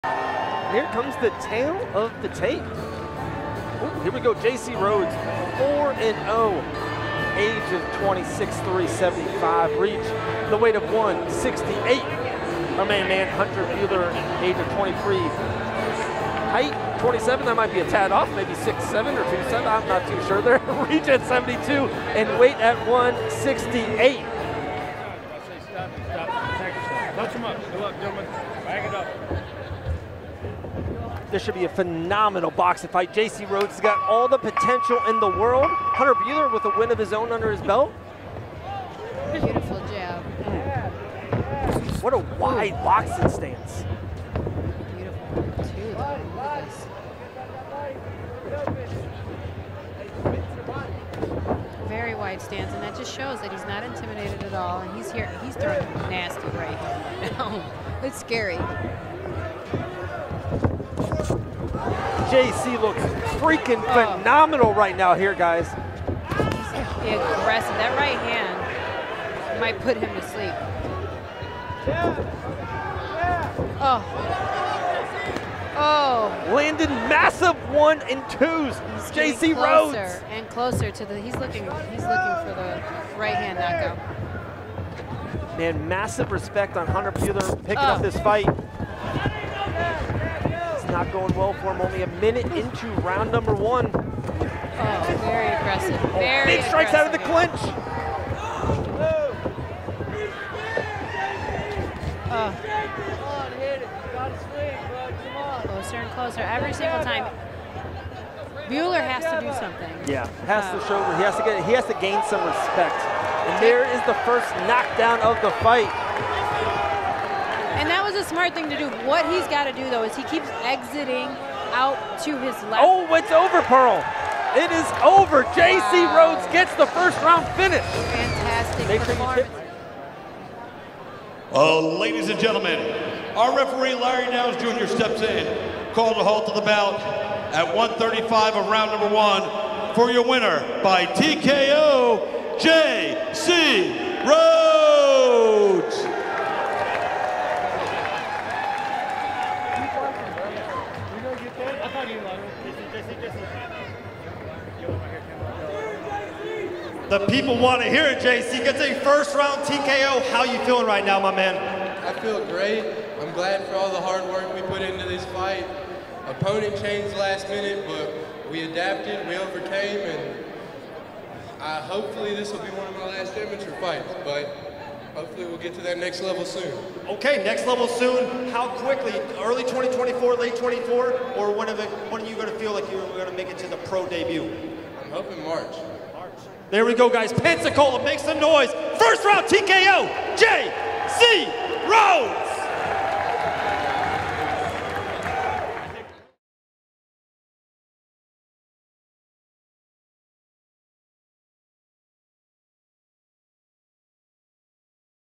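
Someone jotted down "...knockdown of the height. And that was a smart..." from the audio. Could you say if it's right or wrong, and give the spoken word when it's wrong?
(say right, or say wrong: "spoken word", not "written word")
wrong: "fight", not "height".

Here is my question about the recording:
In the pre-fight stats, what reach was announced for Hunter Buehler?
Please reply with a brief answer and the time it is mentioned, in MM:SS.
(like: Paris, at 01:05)
72, at 00:20.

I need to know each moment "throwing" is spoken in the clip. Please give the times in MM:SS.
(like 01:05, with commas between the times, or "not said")
00:55.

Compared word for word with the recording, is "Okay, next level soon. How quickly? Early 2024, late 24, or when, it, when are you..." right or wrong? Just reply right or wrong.
right.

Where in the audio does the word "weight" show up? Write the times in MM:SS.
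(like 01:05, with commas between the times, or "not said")
00:10, 00:22.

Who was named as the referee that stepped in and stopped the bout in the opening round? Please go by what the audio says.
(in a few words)
Larry Downs Jr.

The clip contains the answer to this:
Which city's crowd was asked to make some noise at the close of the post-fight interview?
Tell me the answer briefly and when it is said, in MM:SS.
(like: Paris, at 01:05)
Pensacola, at 03:07.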